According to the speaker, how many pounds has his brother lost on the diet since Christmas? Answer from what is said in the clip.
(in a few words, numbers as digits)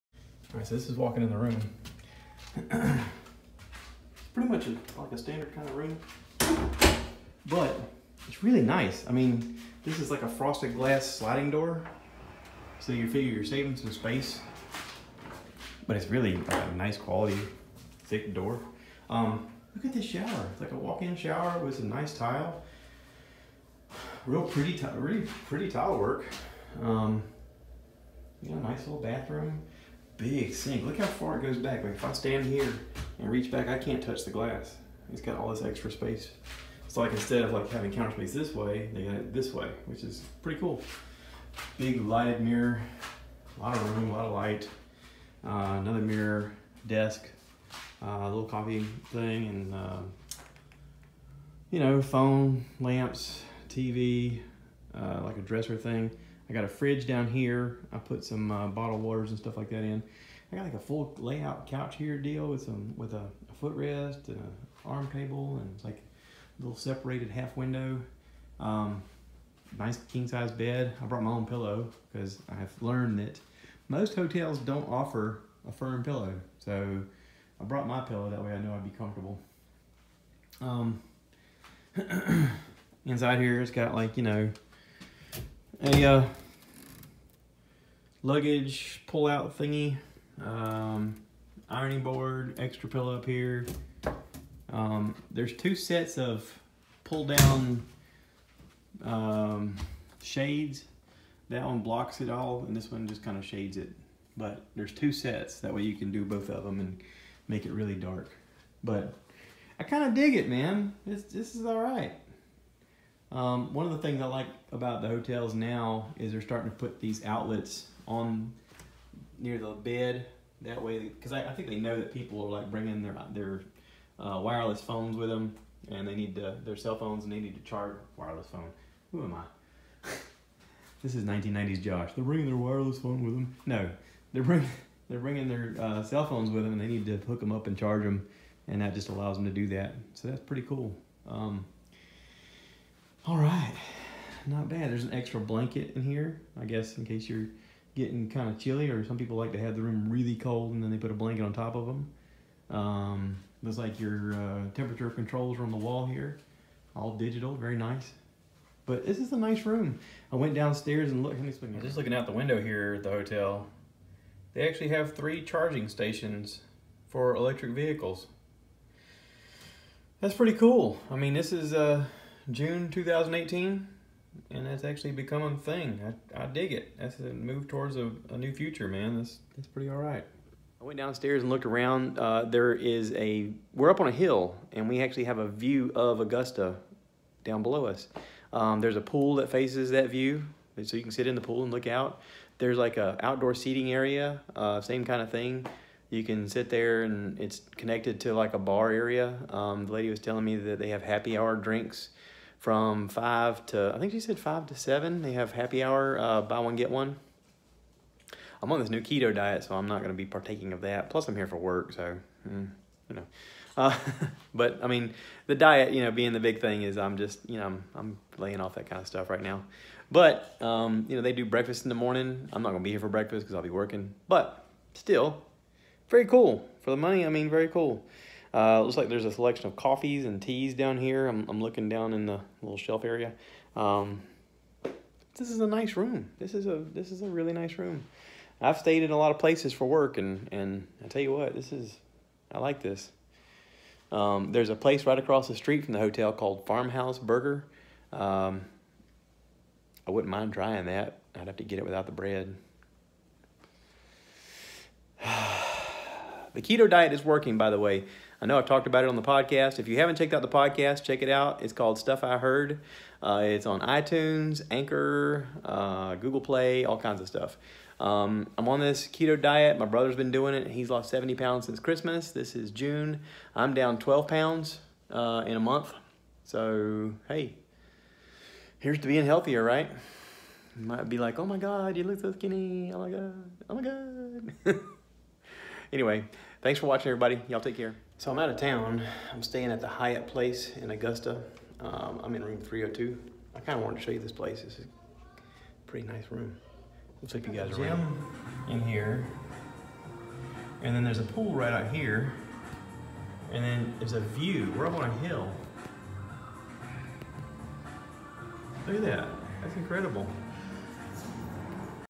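70.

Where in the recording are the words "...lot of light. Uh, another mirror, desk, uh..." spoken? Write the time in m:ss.
0:44.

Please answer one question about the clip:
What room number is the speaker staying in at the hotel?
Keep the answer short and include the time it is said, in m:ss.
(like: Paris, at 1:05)
302, at 4:52.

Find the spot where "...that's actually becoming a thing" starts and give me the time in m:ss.
2:54.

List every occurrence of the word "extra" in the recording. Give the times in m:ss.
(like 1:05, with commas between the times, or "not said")
0:35, 1:32, 2:25.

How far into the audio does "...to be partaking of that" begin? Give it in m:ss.
3:30.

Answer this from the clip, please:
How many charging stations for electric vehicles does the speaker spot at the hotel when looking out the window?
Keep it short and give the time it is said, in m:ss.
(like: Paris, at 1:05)
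3, at 2:45.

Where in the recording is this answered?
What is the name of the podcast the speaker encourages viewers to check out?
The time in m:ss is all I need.
4:21.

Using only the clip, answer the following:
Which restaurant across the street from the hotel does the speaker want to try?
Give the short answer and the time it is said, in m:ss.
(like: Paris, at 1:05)
Farmhouse Burger, at 4:06.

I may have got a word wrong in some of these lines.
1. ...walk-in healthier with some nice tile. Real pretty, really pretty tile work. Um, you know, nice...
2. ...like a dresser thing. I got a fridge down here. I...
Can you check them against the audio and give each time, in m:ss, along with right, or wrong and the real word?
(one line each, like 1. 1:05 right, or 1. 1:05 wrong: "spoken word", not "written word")
1. 0:20 wrong: "shower", not "healthier"
2. 0:55 right.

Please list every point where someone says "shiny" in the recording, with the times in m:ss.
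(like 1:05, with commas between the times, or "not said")
not said.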